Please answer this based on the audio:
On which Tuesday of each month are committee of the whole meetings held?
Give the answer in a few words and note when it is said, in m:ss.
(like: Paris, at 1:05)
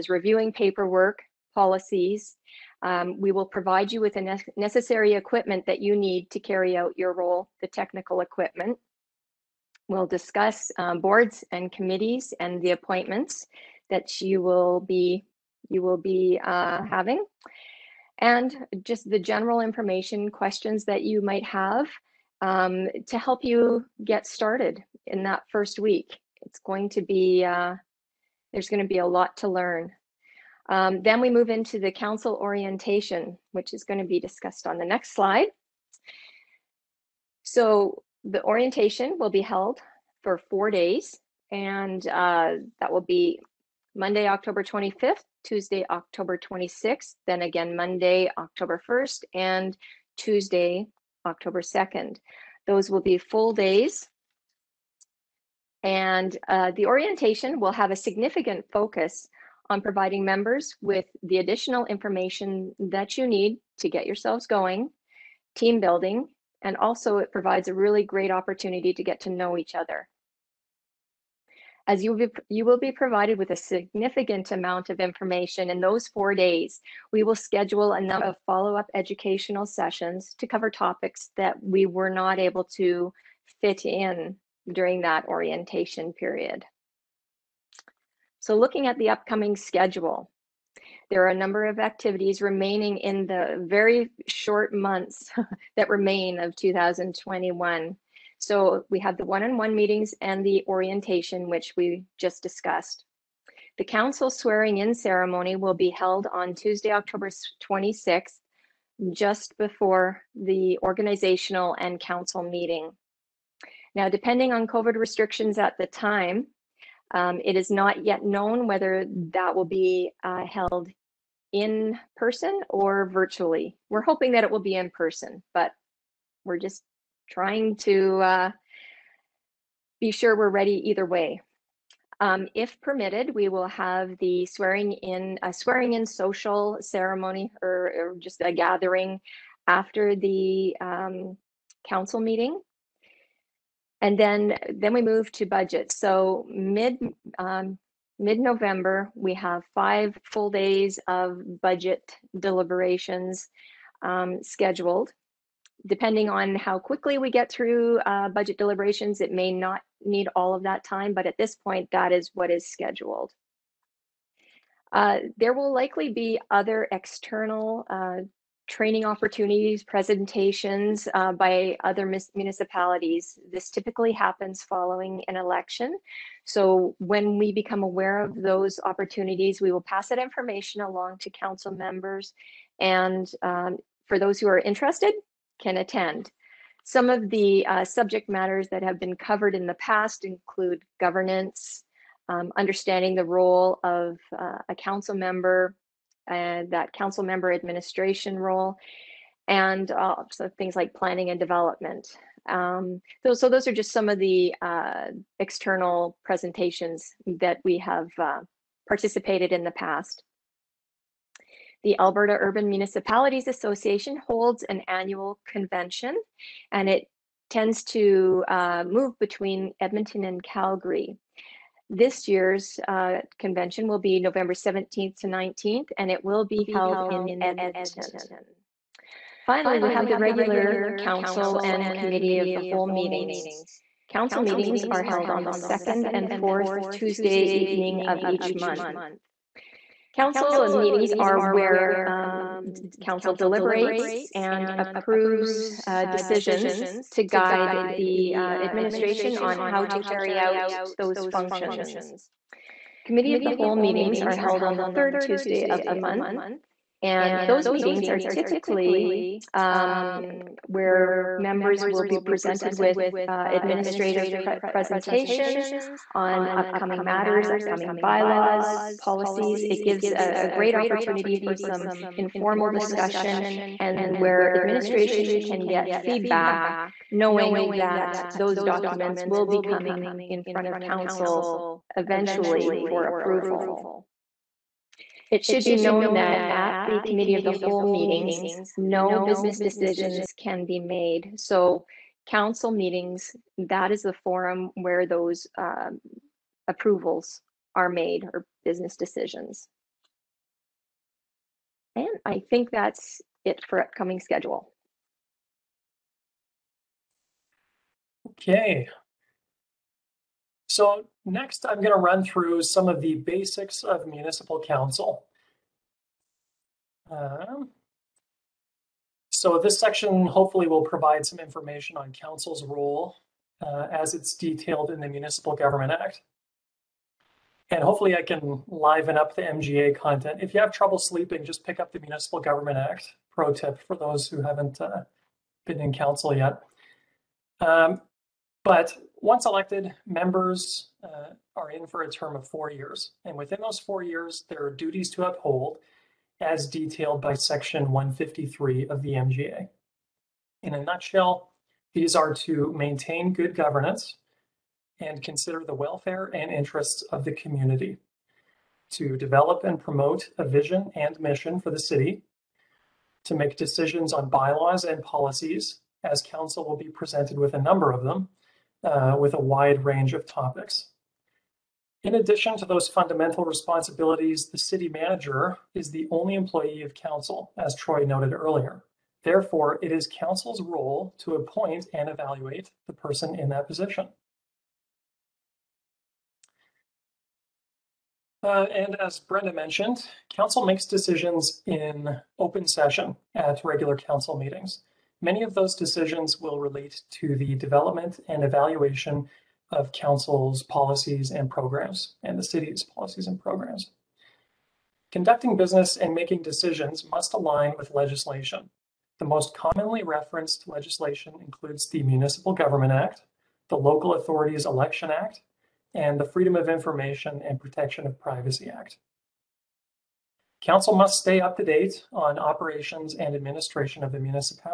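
third Tuesday, at 4:14.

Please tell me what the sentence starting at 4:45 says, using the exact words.
It should be known that at the committee of the whole meetings, no business decisions can be made.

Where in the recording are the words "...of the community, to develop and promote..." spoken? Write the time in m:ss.
5:57.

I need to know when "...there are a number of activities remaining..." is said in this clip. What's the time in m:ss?
1:31.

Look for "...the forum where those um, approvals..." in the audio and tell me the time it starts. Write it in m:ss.
4:54.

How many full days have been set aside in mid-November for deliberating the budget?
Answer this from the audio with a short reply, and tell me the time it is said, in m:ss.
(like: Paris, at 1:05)
5, at 2:29.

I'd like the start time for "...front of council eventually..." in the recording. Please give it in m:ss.
4:40.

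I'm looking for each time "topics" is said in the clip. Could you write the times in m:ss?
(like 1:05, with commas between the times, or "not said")
1:20, 6:10.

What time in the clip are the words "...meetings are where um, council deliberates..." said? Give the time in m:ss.
4:00.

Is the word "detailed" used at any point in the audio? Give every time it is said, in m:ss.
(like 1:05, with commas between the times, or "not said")
5:24, 5:46.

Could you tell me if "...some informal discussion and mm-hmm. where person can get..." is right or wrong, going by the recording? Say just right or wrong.
wrong.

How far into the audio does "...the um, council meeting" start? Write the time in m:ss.
2:20.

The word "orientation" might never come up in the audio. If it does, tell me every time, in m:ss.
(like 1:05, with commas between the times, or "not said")
0:32, 0:38, 0:56, 1:25, 1:40.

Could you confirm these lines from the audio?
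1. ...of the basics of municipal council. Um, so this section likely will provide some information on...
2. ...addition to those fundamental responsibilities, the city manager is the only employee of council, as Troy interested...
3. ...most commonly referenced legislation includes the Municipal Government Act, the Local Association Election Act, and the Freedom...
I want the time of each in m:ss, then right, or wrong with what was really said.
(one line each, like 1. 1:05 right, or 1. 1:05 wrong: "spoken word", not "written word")
1. 5:12 wrong: "hopefully", not "likely"
2. 6:12 wrong: "noted", not "interested"
3. 6:49 wrong: "Authorities", not "Association".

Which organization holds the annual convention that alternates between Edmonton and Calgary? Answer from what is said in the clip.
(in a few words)
Alberta Urban Municipalities Association.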